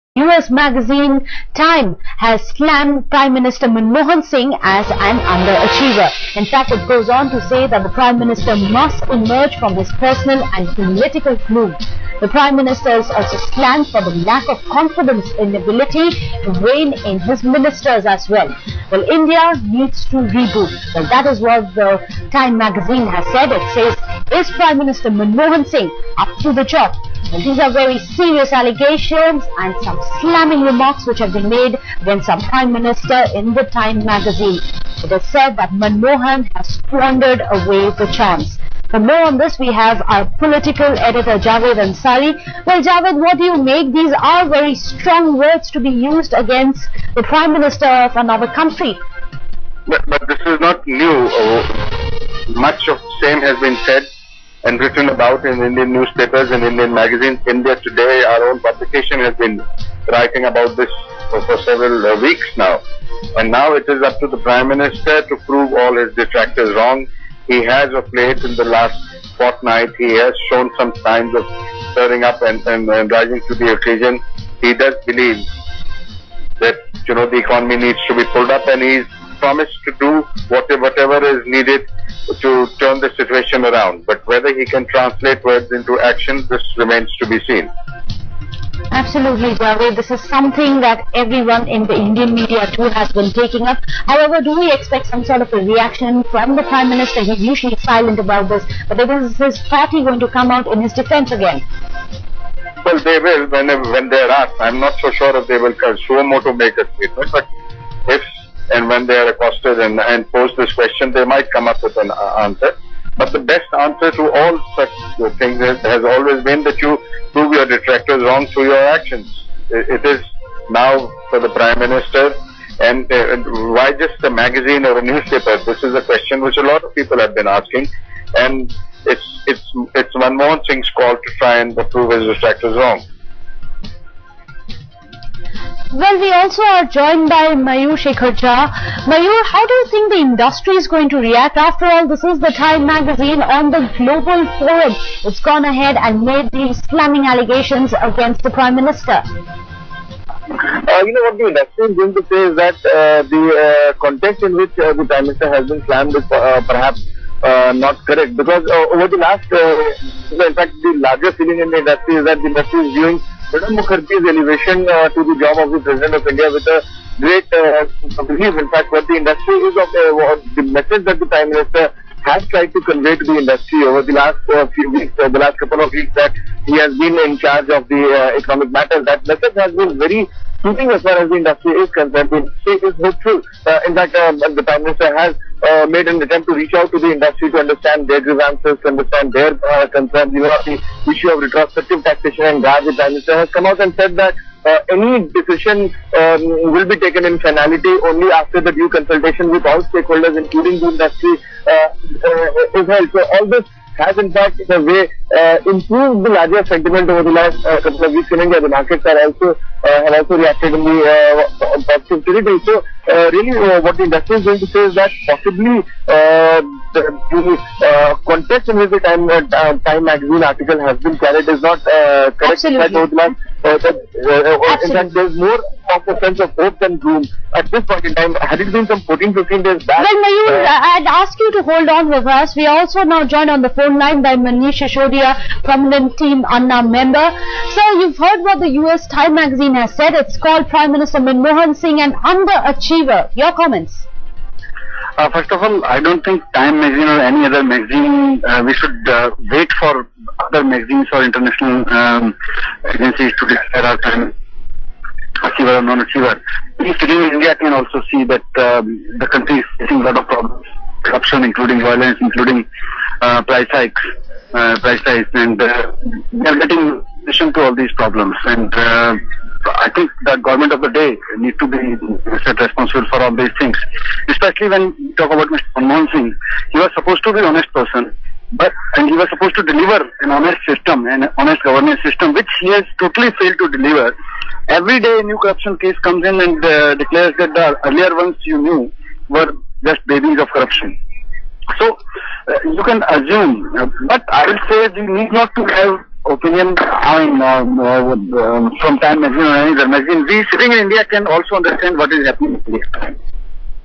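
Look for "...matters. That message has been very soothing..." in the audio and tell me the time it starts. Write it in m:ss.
2:58.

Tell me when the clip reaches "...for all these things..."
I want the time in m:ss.
4:33.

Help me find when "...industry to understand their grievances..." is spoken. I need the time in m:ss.
3:07.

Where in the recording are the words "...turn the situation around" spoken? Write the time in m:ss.
1:22.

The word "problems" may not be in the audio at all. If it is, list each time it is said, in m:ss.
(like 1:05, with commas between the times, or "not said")
4:20, 4:27.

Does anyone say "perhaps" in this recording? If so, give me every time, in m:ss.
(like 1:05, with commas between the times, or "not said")
2:36.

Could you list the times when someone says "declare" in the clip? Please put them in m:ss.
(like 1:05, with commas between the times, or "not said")
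4:13, 4:46.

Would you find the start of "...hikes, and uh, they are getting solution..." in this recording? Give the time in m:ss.
4:25.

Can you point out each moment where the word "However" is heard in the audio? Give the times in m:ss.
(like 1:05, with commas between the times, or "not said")
1:34.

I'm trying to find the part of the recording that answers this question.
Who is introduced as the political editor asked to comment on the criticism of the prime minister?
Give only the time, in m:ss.
0:41.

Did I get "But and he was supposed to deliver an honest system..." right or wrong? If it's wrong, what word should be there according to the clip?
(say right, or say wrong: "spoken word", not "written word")
right.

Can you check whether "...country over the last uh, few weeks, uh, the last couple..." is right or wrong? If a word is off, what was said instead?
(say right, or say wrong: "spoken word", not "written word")
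wrong: "industry", not "country".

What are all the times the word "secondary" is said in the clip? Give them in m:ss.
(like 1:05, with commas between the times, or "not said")
not said.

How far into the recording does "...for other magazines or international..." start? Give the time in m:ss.
4:09.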